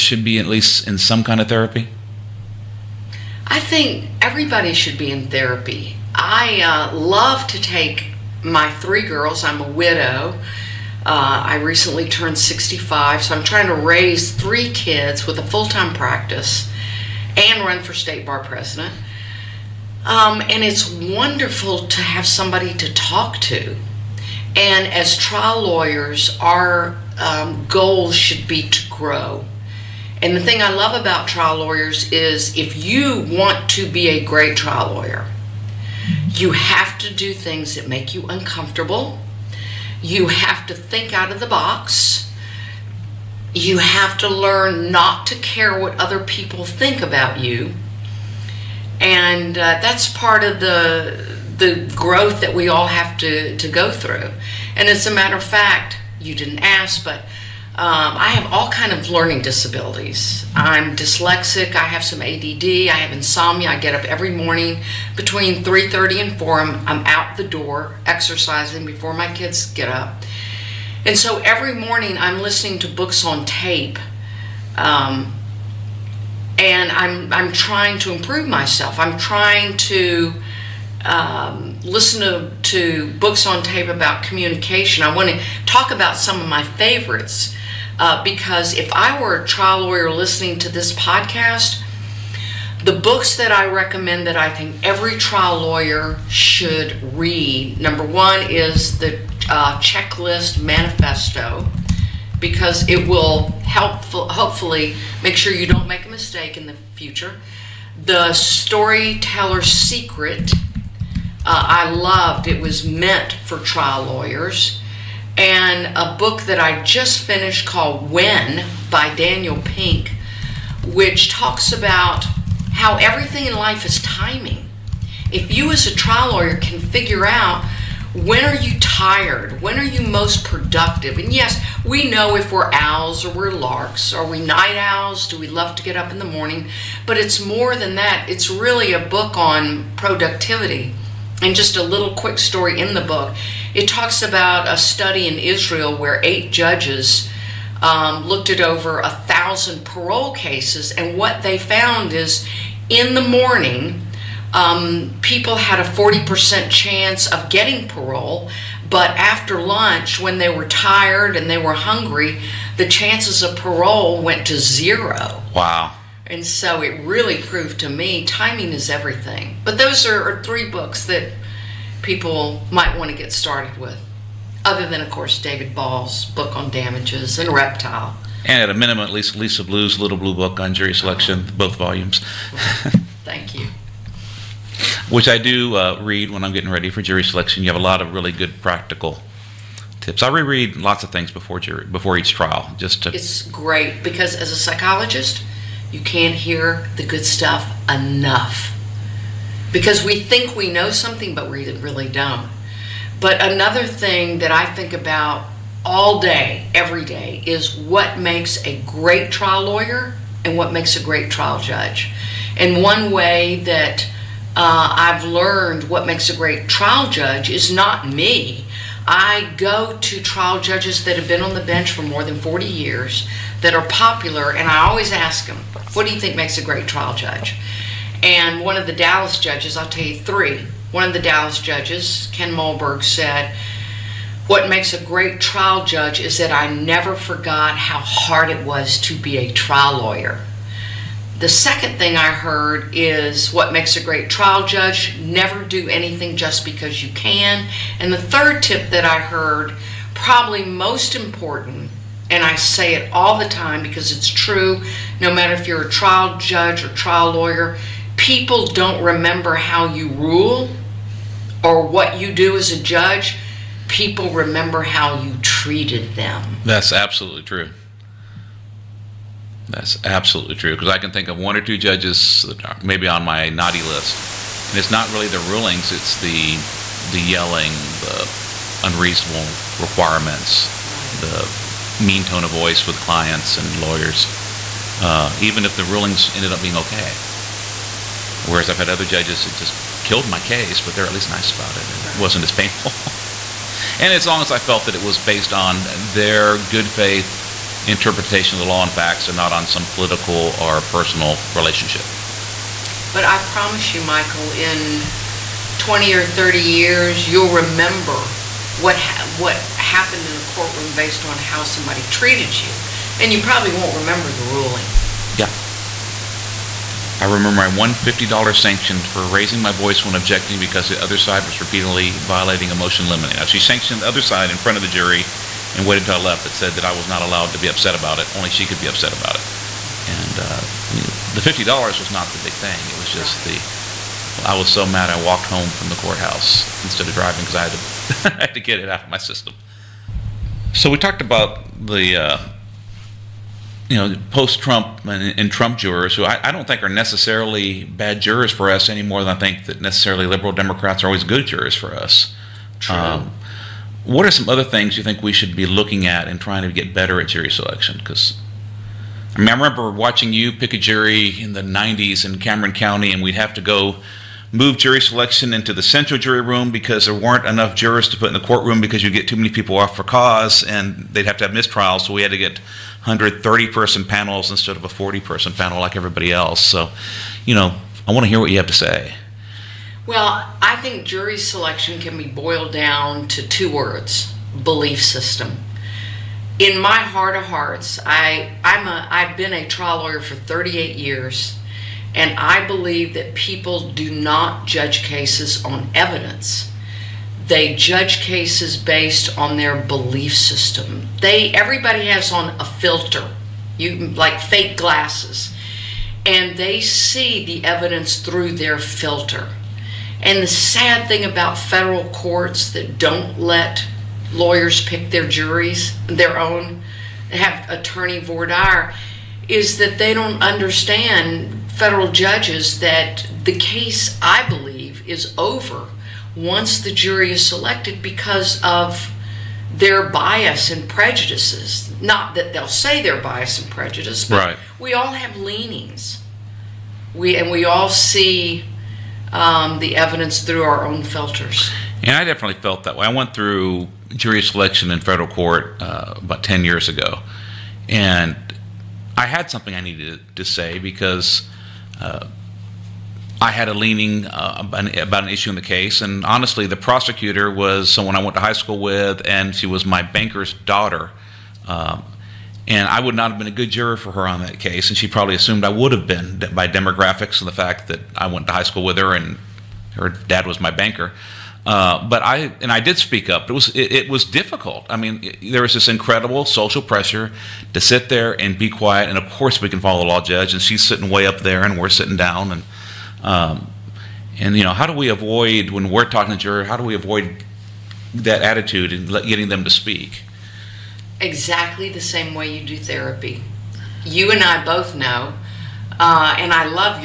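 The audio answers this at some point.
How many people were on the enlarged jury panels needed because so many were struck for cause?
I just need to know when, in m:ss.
6:13.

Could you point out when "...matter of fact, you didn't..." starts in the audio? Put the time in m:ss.
0:55.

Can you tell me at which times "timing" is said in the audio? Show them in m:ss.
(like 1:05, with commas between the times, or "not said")
2:04, 2:48.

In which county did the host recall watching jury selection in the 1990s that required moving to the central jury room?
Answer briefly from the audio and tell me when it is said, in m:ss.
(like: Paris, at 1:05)
Cameron County, at 6:02.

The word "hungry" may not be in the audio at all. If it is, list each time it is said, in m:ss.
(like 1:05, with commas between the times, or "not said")
2:41.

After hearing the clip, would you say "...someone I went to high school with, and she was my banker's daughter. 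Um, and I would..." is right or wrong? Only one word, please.
right.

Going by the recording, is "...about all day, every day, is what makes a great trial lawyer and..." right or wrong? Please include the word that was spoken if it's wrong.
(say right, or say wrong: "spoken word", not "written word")
right.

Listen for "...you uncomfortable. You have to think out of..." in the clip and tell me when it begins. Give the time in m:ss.
0:38.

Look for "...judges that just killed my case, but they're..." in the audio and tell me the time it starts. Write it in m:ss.
4:49.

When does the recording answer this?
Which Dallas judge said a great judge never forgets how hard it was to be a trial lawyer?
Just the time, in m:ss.
3:52.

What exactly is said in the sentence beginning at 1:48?
The Storyteller's Secret, uh, I loved.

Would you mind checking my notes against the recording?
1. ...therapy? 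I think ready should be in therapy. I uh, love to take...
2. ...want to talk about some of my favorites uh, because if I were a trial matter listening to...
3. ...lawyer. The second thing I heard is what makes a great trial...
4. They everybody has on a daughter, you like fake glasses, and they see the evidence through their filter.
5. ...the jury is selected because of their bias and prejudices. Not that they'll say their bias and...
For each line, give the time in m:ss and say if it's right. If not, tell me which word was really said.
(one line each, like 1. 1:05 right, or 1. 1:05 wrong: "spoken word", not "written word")
1. 0:01 wrong: "everybody", not "ready"
2. 1:25 wrong: "lawyer", not "matter"
3. 3:59 right
4. 6:41 wrong: "filter", not "daughter"
5. 7:06 right.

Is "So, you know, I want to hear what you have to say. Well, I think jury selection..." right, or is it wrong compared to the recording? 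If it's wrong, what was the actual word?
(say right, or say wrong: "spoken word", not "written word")
right.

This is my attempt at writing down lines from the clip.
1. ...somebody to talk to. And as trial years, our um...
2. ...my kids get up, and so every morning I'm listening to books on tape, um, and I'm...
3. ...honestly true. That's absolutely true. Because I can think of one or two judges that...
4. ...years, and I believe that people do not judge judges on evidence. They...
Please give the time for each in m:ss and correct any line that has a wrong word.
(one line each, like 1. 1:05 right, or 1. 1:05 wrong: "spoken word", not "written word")
1. 0:22 wrong: "lawyers", not "years"
2. 1:09 right
3. 4:26 wrong: "absolutely", not "honestly"
4. 6:30 wrong: "cases", not "judges".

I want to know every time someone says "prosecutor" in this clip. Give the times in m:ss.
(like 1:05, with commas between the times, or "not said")
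7:36.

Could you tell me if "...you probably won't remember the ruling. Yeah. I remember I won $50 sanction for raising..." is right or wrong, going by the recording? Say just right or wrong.
right.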